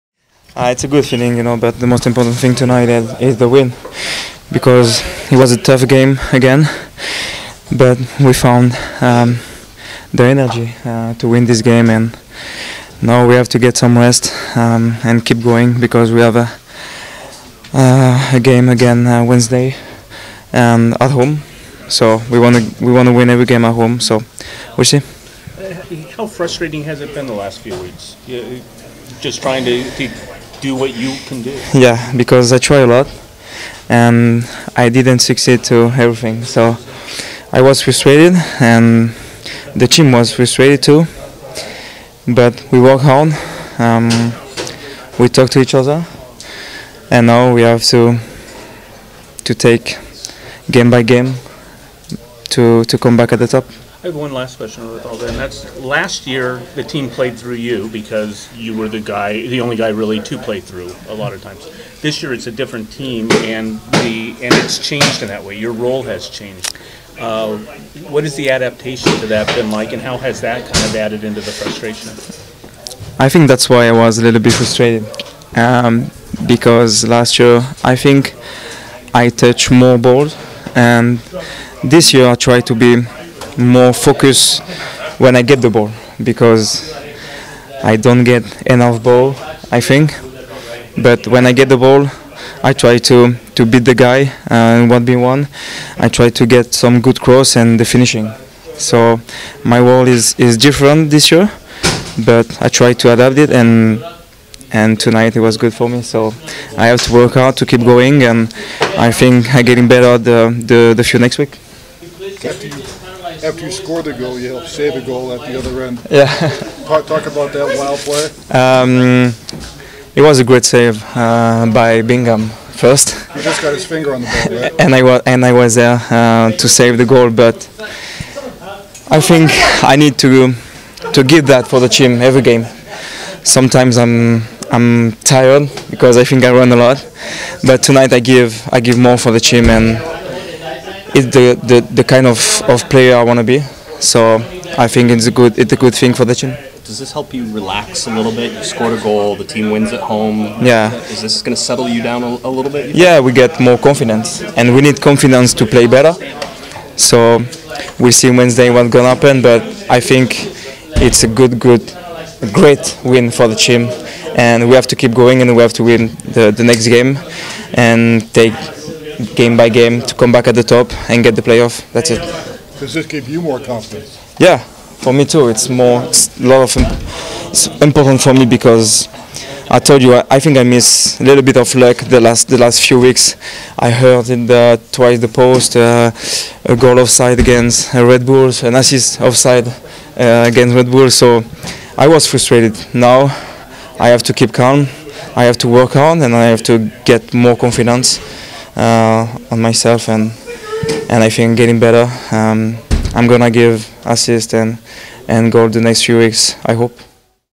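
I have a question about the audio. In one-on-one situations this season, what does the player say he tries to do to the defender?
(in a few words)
beat the guy.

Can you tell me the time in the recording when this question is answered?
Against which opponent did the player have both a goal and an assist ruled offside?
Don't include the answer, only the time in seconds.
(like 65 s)
187 s.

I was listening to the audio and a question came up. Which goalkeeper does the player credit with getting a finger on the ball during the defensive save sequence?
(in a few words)
Bingham.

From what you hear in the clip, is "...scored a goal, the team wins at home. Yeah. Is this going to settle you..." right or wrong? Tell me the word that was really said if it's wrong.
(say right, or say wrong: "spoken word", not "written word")
right.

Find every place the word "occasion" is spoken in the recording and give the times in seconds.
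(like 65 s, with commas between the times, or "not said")
not said.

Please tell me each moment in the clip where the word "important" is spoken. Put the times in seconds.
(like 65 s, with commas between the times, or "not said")
2 s, 177 s.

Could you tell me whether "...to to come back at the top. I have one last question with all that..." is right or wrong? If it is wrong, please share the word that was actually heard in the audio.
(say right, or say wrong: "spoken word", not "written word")
right.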